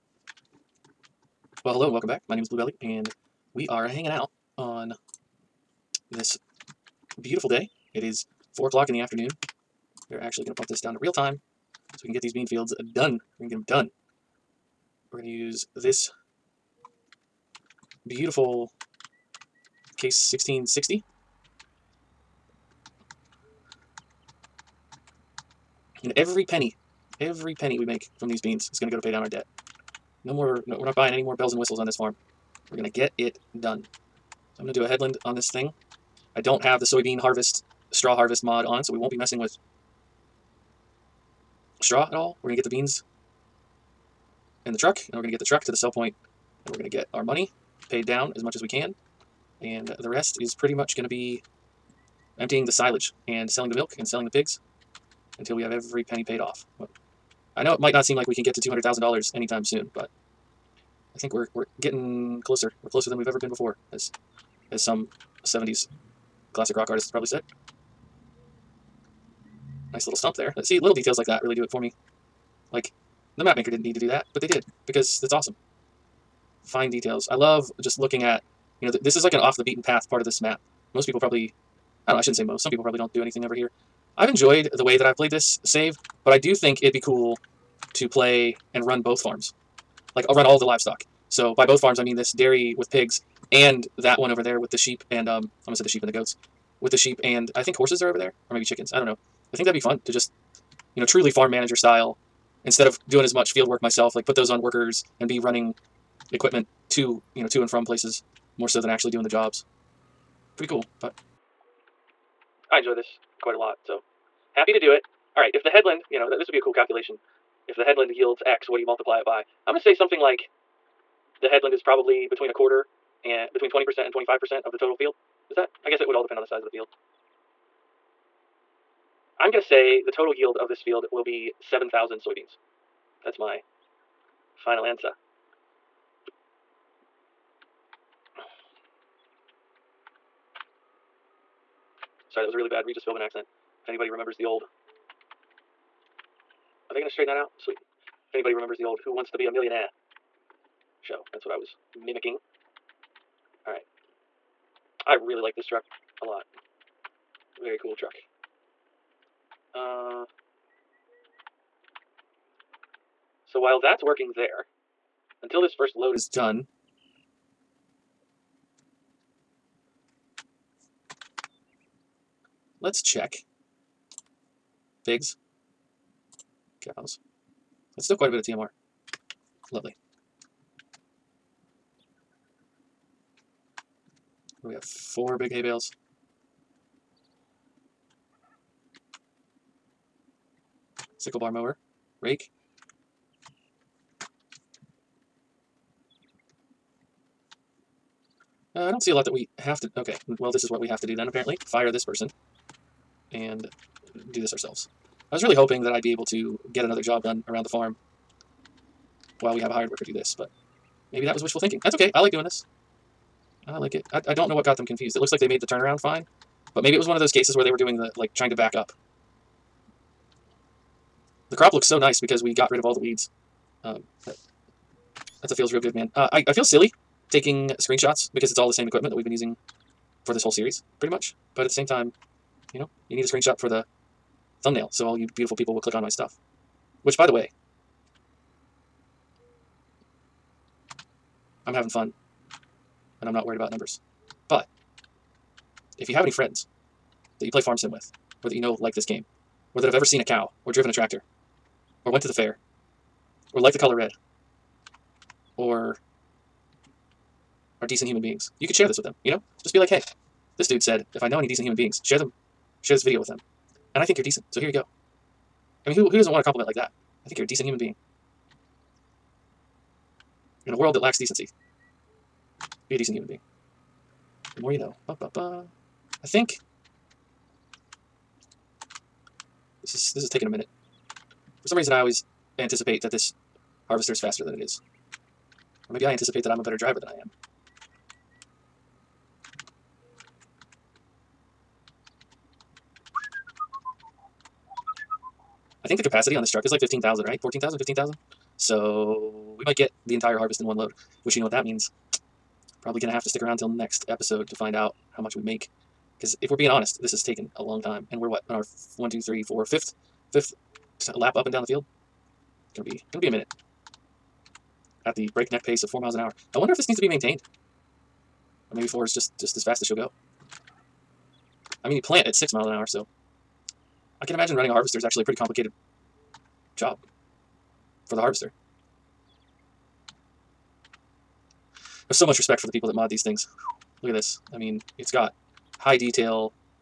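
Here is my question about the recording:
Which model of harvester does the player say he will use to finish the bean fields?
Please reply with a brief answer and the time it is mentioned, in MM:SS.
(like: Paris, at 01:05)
Case 1660, at 00:19.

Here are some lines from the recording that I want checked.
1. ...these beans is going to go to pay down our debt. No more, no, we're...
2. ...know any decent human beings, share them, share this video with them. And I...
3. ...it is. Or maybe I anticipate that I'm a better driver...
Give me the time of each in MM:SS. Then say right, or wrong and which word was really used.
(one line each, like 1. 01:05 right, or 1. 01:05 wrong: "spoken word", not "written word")
1. 00:28 right
2. 04:21 right
3. 04:44 right.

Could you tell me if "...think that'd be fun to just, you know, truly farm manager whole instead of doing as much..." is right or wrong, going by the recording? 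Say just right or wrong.
wrong.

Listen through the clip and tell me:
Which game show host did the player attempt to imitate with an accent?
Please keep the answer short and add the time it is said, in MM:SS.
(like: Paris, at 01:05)
Regis Philbin, at 02:22.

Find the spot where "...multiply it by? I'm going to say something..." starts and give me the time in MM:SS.
01:58.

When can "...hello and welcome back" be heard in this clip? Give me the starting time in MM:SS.
00:01.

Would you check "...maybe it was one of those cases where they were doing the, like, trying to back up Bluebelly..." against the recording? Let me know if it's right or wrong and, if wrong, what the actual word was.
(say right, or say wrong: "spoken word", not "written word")
wrong: "The", not "Bluebelly".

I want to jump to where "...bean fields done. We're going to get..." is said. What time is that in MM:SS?
00:12.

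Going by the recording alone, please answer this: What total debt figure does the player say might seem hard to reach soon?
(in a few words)
$200,000.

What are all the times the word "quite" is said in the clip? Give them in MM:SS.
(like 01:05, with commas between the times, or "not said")
01:53, 02:58.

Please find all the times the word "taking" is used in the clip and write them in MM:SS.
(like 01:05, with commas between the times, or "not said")
03:47, 04:40.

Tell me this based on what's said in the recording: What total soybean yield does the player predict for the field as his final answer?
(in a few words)
7,000.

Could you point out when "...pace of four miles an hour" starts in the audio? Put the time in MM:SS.
05:15.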